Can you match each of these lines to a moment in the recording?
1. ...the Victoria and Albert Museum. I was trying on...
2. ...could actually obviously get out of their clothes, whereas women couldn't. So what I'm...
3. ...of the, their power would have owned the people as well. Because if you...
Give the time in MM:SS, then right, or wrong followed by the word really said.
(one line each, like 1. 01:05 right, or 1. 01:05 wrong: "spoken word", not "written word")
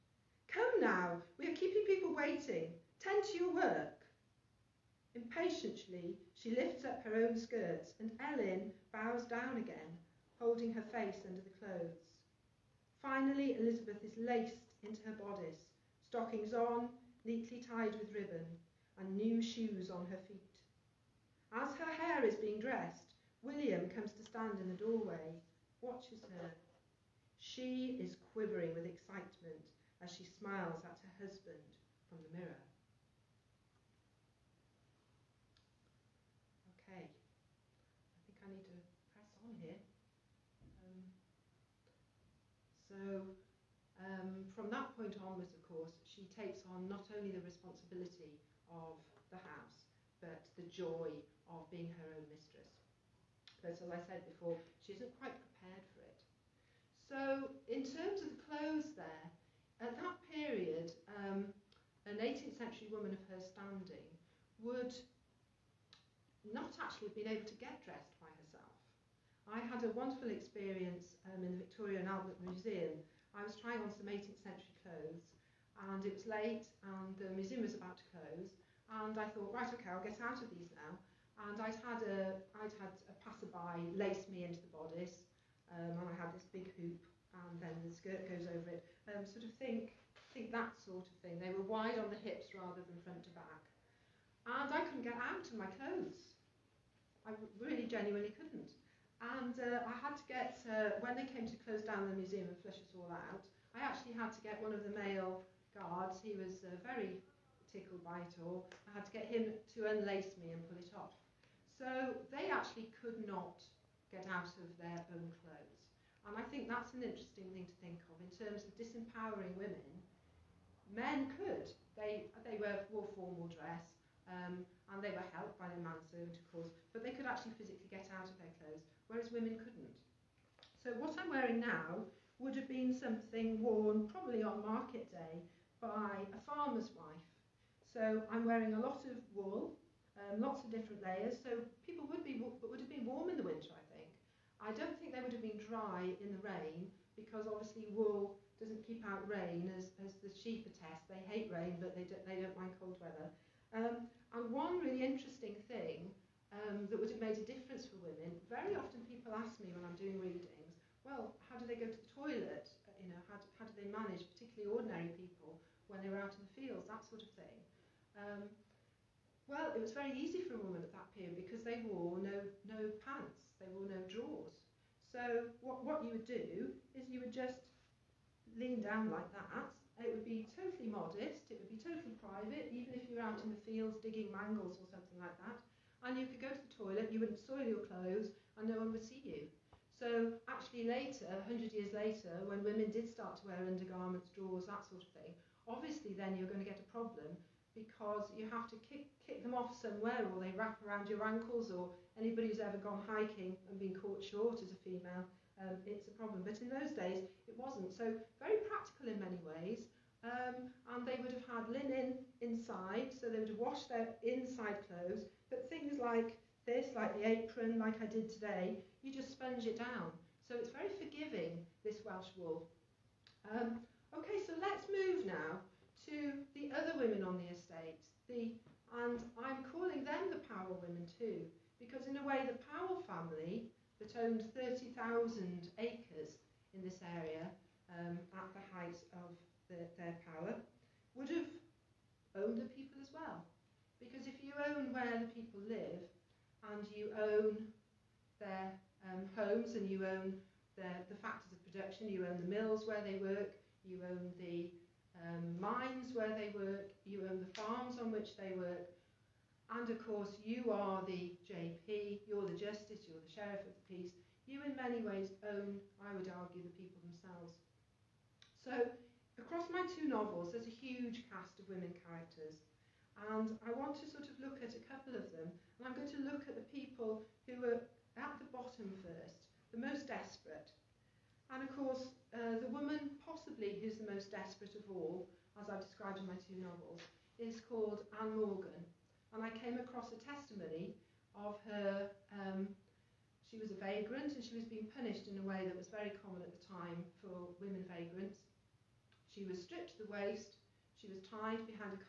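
1. 01:11 right
2. 02:07 wrong: "physically", not "obviously"
3. 03:59 right.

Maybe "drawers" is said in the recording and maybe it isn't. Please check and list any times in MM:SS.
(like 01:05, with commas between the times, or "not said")
02:54, 03:14.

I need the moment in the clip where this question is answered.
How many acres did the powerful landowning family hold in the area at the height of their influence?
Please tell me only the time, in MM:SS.
03:54.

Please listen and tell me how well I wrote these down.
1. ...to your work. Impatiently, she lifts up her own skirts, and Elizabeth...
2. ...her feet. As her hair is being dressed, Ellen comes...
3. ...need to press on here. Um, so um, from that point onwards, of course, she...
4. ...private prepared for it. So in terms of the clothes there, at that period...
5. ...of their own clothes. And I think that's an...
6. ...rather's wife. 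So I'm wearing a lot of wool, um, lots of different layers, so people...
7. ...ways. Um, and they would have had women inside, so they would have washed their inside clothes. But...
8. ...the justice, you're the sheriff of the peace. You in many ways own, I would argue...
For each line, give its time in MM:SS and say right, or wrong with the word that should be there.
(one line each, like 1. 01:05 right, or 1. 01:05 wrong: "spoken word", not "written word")
1. 00:03 wrong: "Ellen", not "Elizabeth"
2. 00:20 wrong: "William", not "Ellen"
3. 00:38 right
4. 00:55 wrong: "quite", not "private"
5. 01:54 right
6. 02:16 wrong: "farmer", not "rather"
7. 03:29 wrong: "linen", not "women"
8. 04:22 right.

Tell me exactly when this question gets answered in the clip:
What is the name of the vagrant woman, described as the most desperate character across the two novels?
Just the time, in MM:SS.
04:48.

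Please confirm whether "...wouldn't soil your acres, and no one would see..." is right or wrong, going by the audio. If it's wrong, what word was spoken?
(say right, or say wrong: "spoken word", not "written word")
wrong: "clothes", not "acres".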